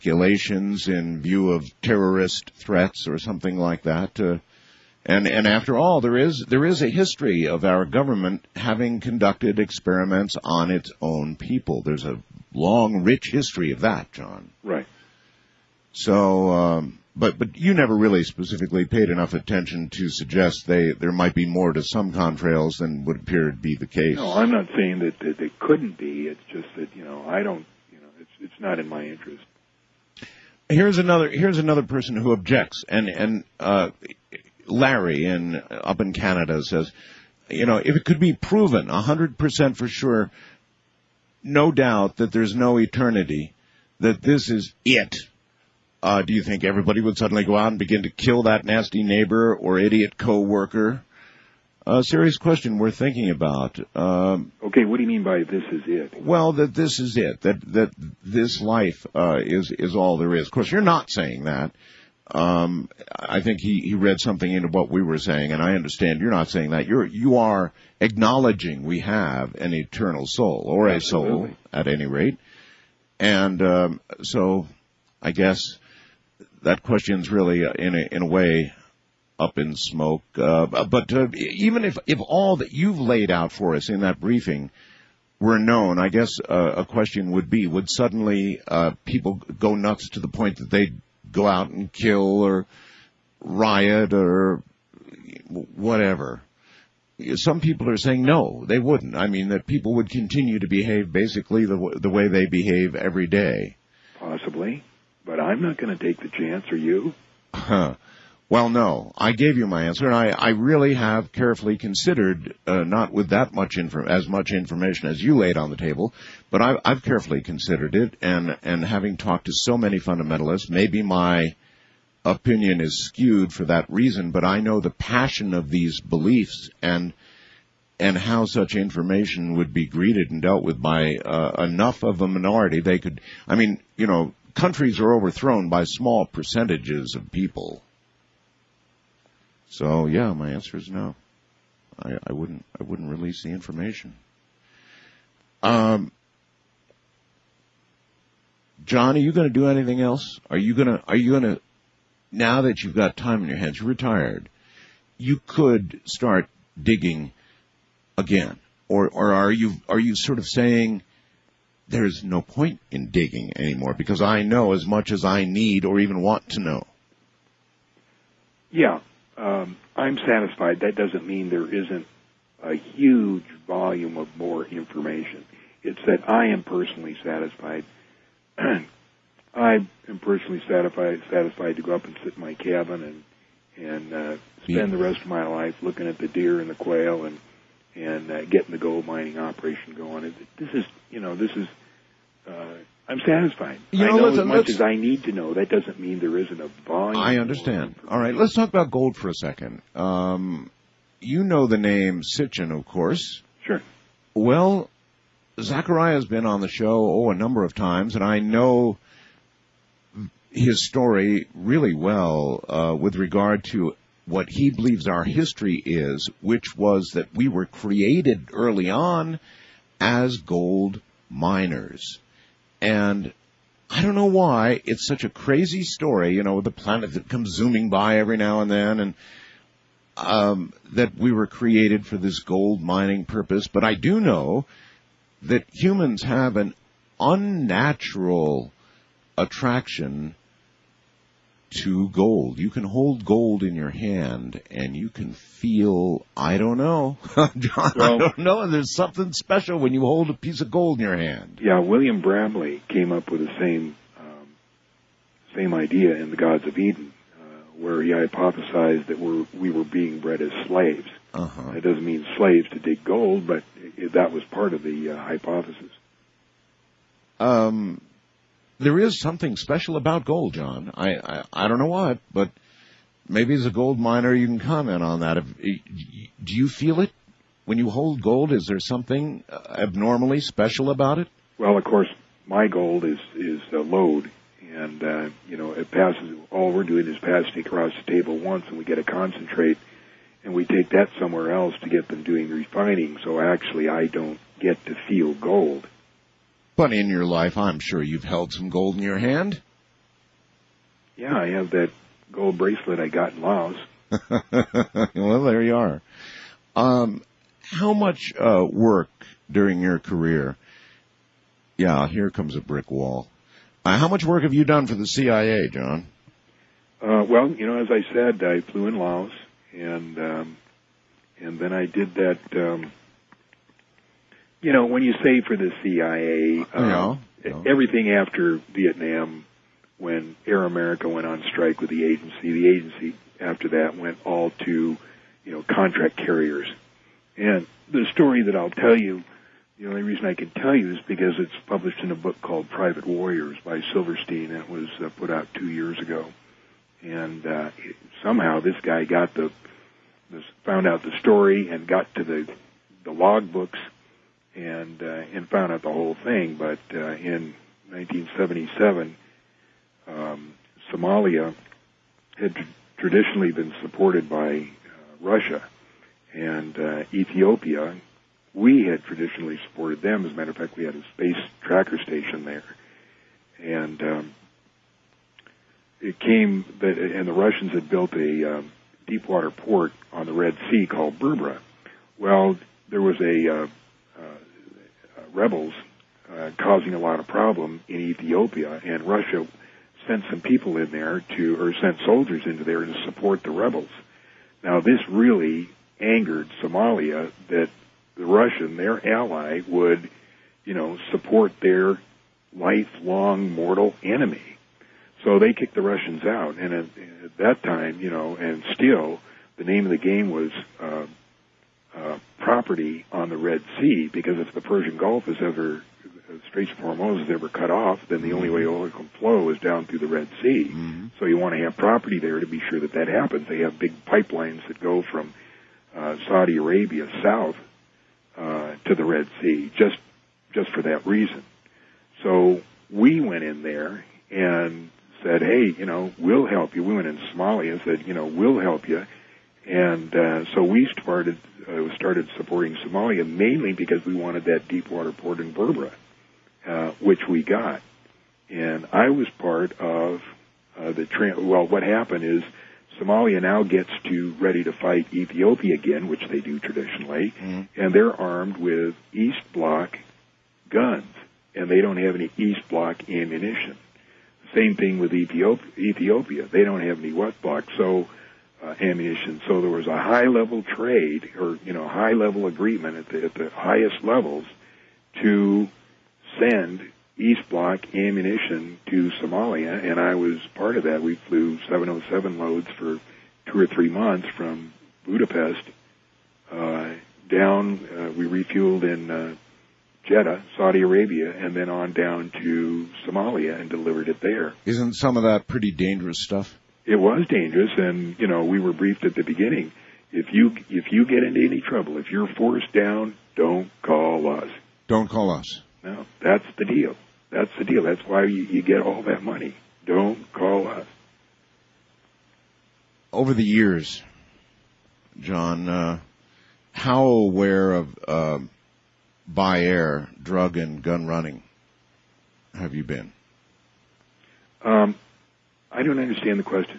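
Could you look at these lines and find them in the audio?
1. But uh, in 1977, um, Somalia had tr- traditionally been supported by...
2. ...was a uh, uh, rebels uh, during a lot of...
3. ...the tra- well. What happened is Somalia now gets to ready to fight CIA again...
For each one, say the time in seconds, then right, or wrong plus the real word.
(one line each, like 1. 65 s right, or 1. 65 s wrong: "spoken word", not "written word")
1. 356 s right
2. 383 s wrong: "causing", not "during"
3. 450 s wrong: "Ethiopia", not "CIA".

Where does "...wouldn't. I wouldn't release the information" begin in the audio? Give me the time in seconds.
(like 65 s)
142 s.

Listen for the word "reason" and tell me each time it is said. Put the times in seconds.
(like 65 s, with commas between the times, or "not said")
123 s, 340 s, 431 s.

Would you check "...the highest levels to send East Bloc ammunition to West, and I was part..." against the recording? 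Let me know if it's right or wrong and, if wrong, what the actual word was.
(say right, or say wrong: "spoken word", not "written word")
wrong: "Somalia", not "West".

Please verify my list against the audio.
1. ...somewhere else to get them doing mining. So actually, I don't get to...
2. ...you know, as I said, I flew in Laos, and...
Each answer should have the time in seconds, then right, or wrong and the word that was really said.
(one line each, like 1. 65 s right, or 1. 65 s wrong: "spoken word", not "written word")
1. 291 s wrong: "refining", not "mining"
2. 317 s right.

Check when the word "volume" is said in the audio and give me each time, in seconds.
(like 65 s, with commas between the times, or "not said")
173 s, 196 s.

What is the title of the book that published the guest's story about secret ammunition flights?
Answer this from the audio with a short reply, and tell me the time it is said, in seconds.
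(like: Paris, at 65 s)
Private Warriors, at 342 s.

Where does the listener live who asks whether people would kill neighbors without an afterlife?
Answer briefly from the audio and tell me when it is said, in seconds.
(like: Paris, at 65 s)
Canada, at 36 s.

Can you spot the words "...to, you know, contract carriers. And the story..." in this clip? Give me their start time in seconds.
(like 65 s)
334 s.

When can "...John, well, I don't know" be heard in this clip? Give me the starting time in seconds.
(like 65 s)
247 s.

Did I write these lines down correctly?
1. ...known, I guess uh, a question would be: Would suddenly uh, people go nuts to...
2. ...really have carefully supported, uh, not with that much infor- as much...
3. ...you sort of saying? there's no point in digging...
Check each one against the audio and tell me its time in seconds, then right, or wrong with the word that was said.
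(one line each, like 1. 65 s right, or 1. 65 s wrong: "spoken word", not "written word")
1. 85 s right
2. 110 s wrong: "considered", not "supported"
3. 159 s right.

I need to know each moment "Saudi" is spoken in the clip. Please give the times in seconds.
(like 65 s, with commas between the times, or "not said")
426 s, 490 s.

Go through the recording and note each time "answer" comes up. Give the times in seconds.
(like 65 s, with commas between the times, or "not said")
109 s, 140 s.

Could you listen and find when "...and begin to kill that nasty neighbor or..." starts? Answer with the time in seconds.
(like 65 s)
47 s.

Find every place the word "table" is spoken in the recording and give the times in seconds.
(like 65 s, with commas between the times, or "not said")
115 s, 288 s.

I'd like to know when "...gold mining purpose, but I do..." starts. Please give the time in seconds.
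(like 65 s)
232 s.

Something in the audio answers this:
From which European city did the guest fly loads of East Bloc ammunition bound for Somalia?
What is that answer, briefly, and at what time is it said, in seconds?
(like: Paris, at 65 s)
Budapest, at 485 s.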